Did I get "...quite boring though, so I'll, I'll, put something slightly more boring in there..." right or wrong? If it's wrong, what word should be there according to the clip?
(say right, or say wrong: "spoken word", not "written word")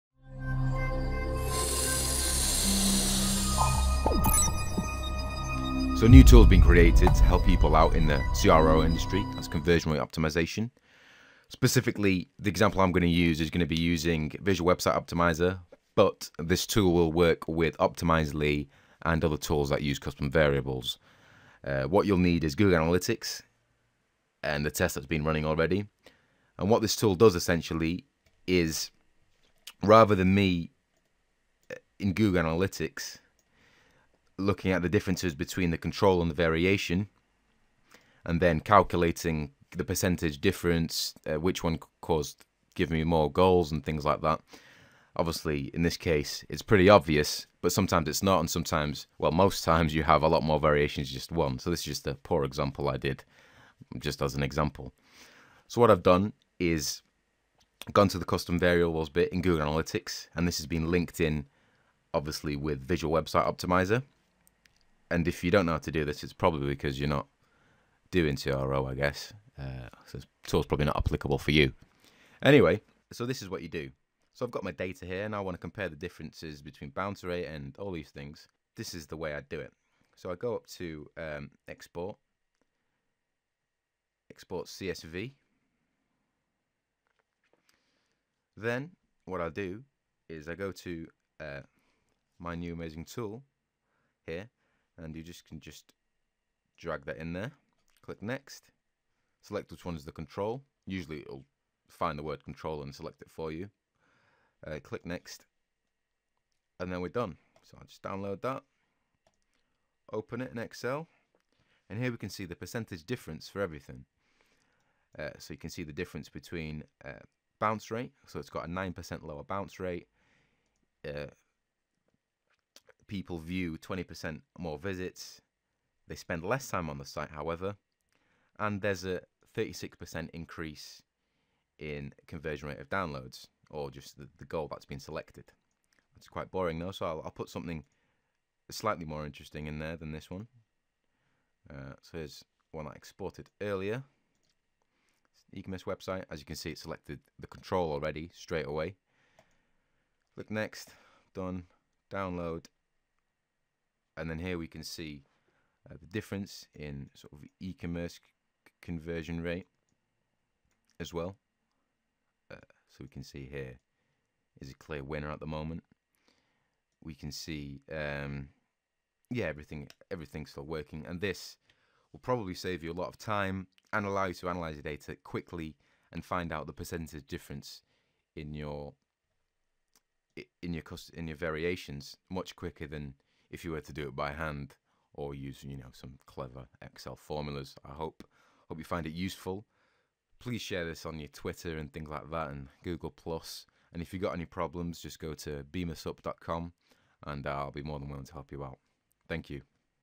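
wrong: "interesting", not "boring".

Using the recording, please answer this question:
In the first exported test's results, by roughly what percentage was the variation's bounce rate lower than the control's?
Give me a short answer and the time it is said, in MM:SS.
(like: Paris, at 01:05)
9%, at 01:58.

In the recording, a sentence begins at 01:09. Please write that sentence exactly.
Uh, so this tool's probably not applicable for you.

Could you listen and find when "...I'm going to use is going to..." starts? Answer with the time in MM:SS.
00:12.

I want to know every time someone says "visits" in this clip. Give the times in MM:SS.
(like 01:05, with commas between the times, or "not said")
02:04.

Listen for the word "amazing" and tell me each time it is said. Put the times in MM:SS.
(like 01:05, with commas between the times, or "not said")
01:32.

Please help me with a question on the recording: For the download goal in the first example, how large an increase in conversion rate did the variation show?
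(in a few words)
36%.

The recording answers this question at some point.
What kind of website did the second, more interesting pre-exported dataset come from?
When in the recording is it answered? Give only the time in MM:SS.
02:25.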